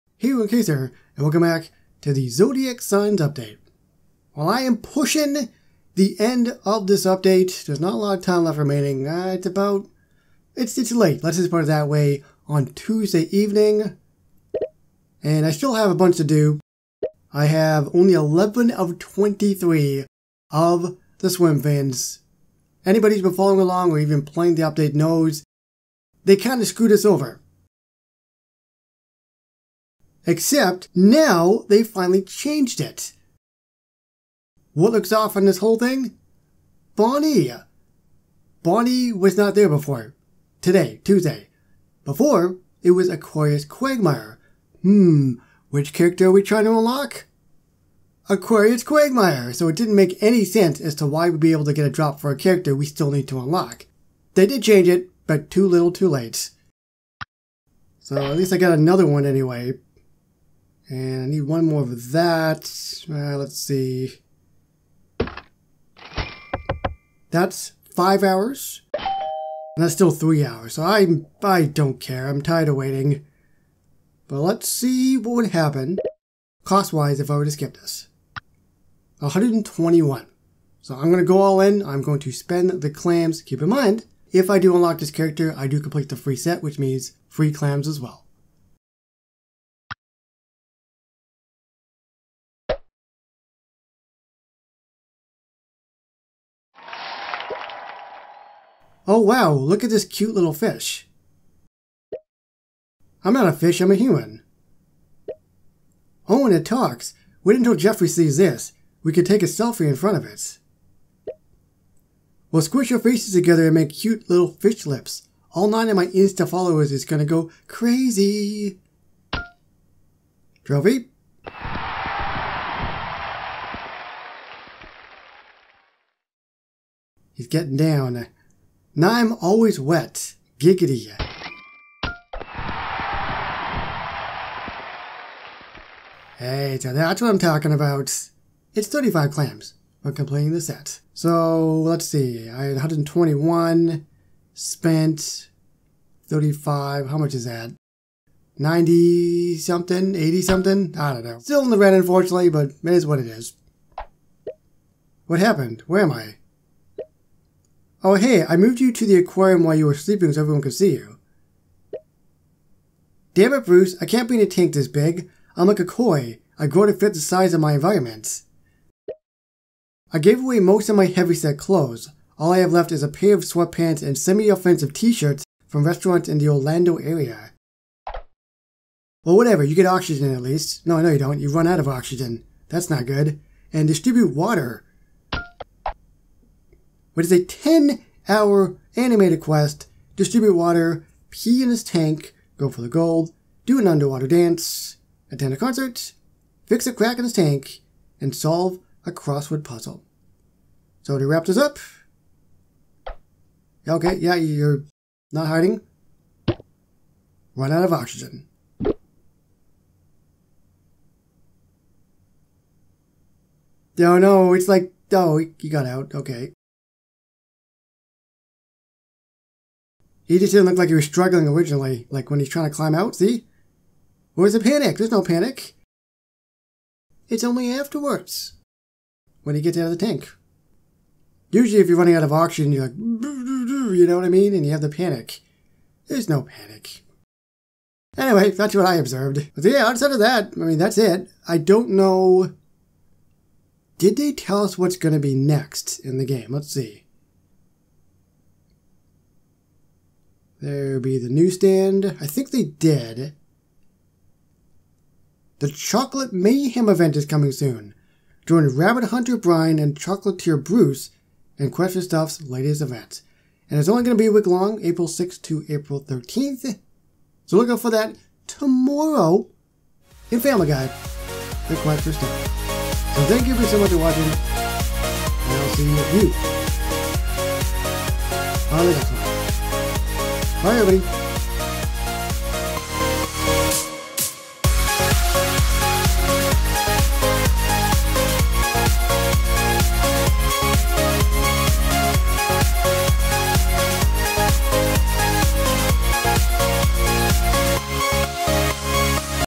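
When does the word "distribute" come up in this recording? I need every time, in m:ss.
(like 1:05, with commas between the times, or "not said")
3:03, 3:10.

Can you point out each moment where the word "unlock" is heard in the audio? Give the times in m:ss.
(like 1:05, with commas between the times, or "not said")
0:46, 0:53, 1:24.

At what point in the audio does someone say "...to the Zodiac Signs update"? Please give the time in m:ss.
0:02.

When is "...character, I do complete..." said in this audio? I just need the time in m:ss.
1:25.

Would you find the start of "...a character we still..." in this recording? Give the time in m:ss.
0:52.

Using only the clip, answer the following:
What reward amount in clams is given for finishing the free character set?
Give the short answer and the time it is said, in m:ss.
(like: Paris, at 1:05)
35, at 2:18.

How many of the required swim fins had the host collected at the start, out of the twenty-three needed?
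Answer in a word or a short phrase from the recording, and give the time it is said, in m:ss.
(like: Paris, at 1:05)
11, at 0:18.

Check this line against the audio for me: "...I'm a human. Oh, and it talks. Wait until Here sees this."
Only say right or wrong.
wrong.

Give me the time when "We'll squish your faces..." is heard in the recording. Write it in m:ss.
1:52.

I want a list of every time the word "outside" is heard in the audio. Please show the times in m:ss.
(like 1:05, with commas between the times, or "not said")
3:59.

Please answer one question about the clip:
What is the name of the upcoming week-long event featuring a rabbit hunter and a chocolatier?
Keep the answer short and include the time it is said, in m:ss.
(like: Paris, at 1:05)
Chocolate Mayhem, at 4:15.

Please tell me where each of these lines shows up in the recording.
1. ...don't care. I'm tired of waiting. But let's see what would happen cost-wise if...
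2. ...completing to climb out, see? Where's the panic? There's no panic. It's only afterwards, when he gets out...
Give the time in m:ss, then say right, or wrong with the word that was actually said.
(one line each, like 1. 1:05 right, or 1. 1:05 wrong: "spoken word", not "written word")
1. 1:11 right
2. 3:42 wrong: "trying", not "completing".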